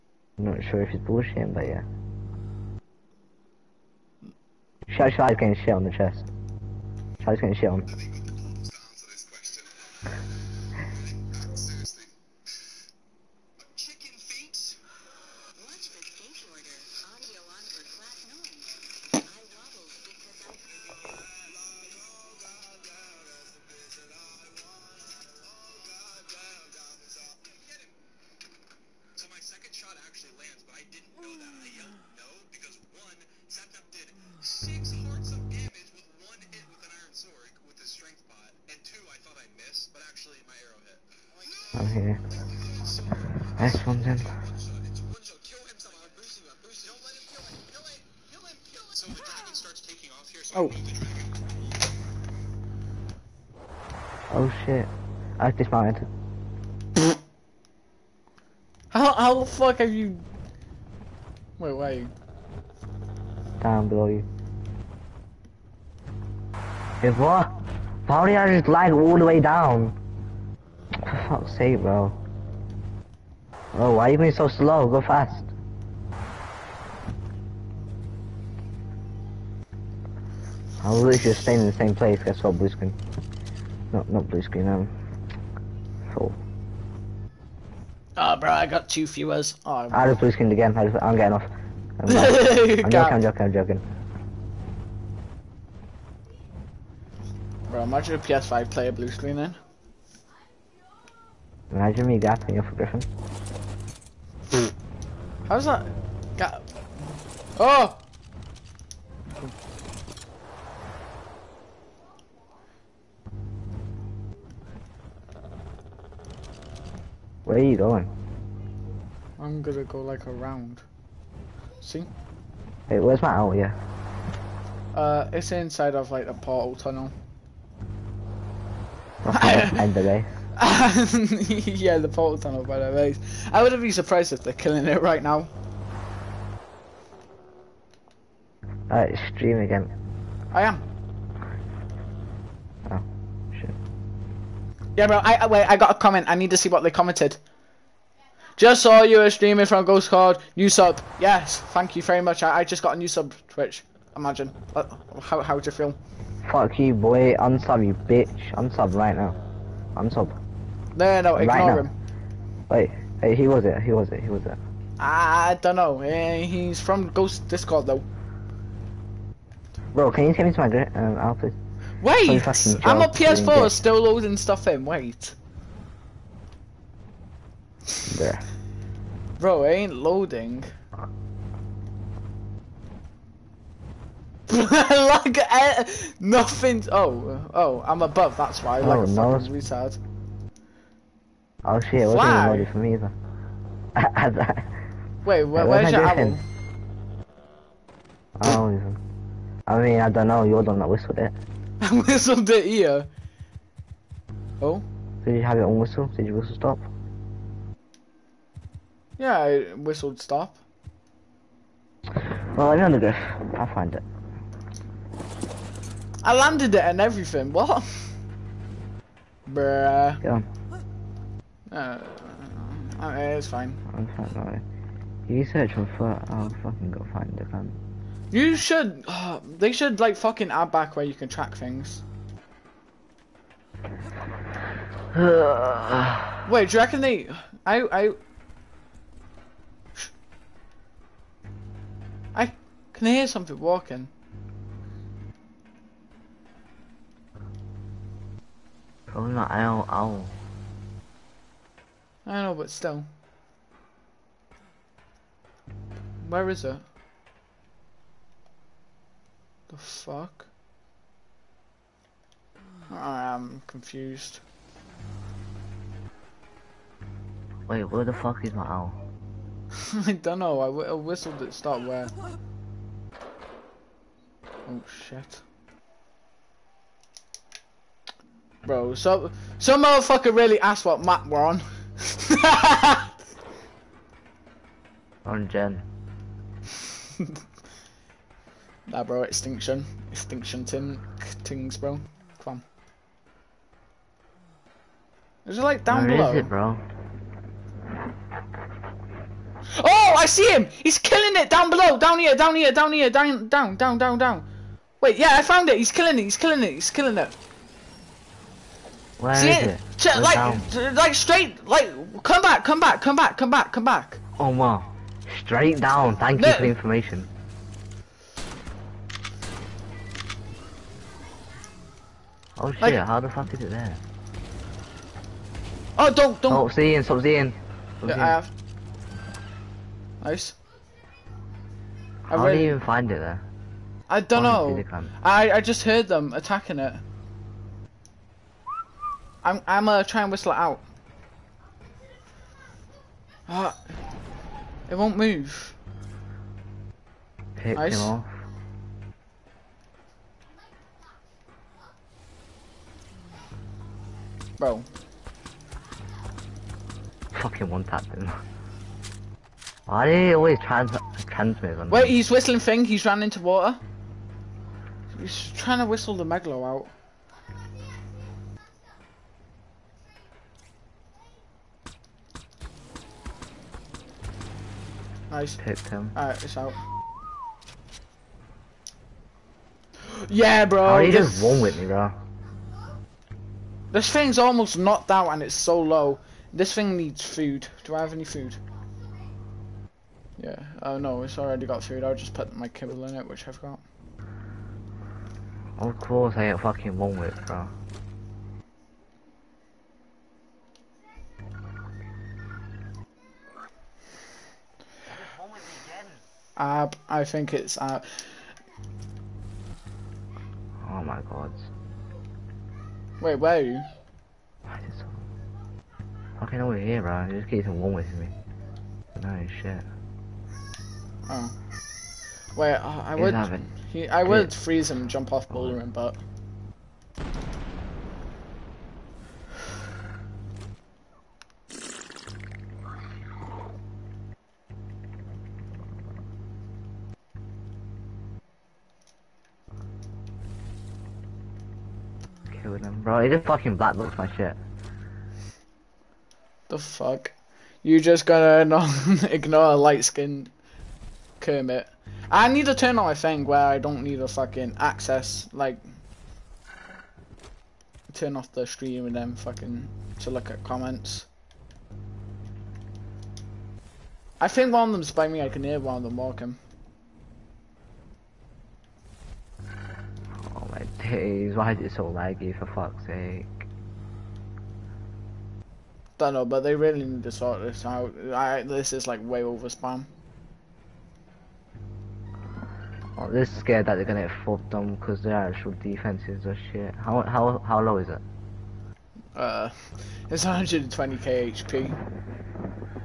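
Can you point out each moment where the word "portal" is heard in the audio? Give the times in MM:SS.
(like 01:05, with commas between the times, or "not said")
02:06, 02:12.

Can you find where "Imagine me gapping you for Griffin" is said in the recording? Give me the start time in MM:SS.
01:41.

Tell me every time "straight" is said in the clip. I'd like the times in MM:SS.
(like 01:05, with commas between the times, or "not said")
05:11, 05:15.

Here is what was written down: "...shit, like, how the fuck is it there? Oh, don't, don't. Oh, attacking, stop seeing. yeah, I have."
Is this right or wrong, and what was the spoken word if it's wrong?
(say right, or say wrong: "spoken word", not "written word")
wrong: "seeing", not "attacking".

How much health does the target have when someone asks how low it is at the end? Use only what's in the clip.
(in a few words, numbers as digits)
120k HP.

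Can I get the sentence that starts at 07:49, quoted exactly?
Oh my days, why is it so laggy for fuck's sake?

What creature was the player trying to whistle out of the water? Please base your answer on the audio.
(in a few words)
Megalo.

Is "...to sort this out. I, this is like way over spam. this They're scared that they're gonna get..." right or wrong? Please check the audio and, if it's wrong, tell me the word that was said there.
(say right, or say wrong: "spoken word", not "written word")
right.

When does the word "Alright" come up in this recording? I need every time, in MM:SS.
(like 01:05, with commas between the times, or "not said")
02:18, 06:16.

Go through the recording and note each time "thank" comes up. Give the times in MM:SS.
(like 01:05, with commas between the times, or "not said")
02:31, 05:16.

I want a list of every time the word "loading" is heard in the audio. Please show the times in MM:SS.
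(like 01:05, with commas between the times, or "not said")
02:54, 02:59, 03:12.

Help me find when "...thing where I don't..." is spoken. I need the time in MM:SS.
07:33.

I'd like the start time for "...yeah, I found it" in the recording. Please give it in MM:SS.
05:05.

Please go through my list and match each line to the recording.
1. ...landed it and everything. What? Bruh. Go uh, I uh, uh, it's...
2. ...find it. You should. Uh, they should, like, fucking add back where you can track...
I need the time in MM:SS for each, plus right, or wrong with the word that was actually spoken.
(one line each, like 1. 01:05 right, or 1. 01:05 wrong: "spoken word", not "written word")
1. 03:36 right
2. 03:47 right.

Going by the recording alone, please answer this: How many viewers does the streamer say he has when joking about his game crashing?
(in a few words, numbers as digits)
2.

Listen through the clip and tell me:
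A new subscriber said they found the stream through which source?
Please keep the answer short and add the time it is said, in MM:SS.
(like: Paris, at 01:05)
Ghost Discord, at 02:47.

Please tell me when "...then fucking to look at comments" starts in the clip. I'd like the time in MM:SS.
07:39.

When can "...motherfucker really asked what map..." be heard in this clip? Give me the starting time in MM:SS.
04:39.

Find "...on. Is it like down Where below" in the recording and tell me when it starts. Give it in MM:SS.
04:52.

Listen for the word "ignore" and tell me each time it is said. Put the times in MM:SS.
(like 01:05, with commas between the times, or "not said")
02:41, 07:29.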